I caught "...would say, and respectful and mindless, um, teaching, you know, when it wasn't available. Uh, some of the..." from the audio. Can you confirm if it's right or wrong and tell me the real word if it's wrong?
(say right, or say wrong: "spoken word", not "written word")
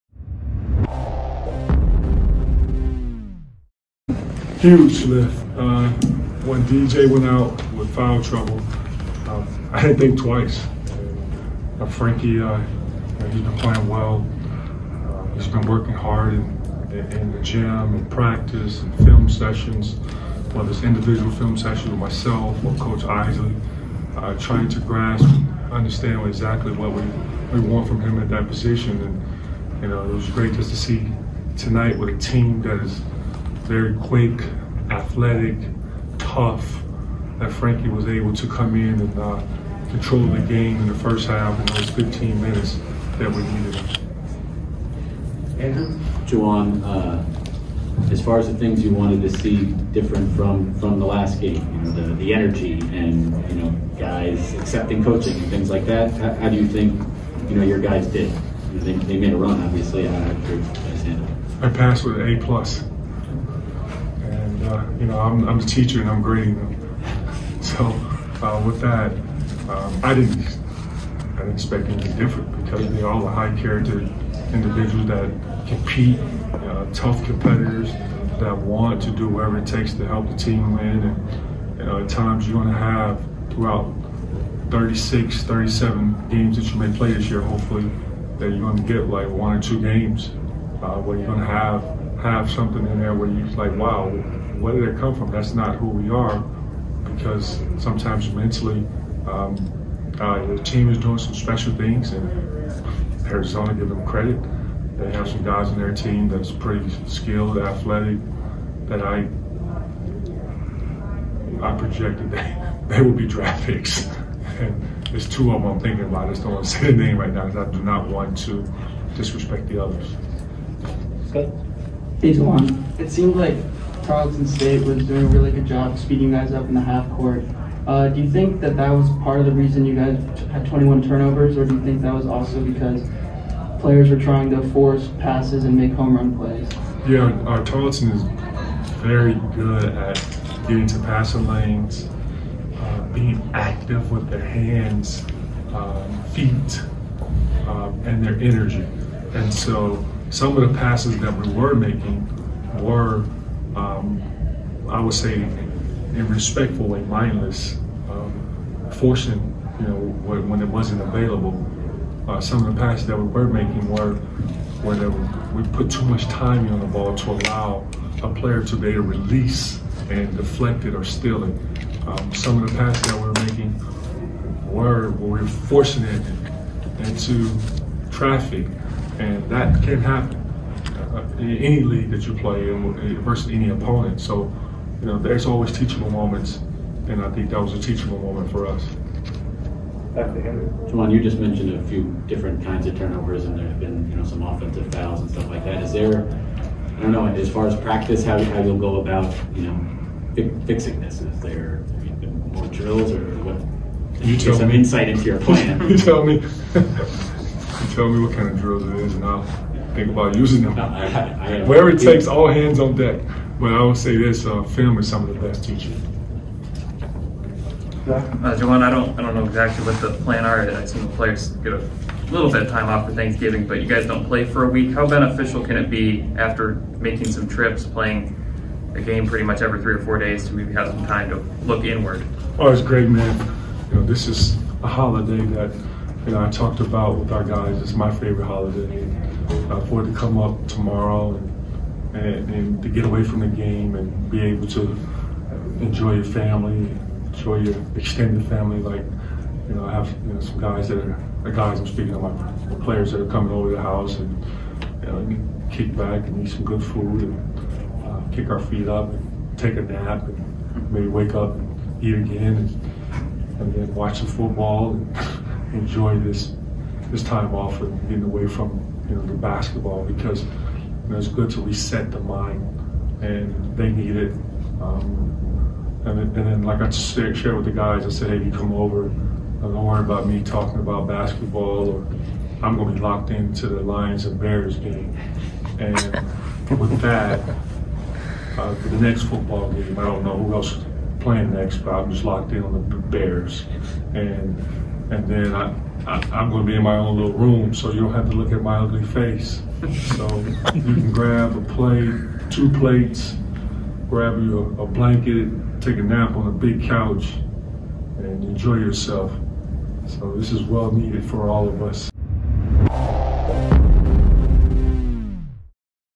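wrong: "forcing", not "teaching".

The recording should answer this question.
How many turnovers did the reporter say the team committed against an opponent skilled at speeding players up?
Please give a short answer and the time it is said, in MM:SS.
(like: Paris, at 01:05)
21, at 02:10.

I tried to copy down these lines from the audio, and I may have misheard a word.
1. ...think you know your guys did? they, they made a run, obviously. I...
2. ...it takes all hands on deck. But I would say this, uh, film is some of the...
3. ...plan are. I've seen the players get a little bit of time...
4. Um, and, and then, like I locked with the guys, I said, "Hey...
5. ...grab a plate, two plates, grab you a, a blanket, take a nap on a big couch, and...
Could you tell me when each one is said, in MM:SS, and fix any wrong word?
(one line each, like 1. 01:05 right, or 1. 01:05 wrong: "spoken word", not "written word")
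1. 00:56 right
2. 03:31 right
3. 03:40 right
4. 04:34 wrong: "shared", not "locked"
5. 05:01 right.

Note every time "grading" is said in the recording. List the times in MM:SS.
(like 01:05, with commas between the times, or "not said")
01:06.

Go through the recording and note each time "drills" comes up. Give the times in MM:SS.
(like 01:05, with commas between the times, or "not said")
03:22, 03:28.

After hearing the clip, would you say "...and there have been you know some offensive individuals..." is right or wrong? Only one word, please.
wrong.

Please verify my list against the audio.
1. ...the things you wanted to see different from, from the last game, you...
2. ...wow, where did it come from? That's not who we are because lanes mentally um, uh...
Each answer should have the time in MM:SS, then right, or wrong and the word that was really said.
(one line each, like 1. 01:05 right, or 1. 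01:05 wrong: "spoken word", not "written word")
1. 00:48 right
2. 01:33 wrong: "sometimes", not "lanes".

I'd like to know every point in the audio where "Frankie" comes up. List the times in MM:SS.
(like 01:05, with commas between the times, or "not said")
00:11, 00:37.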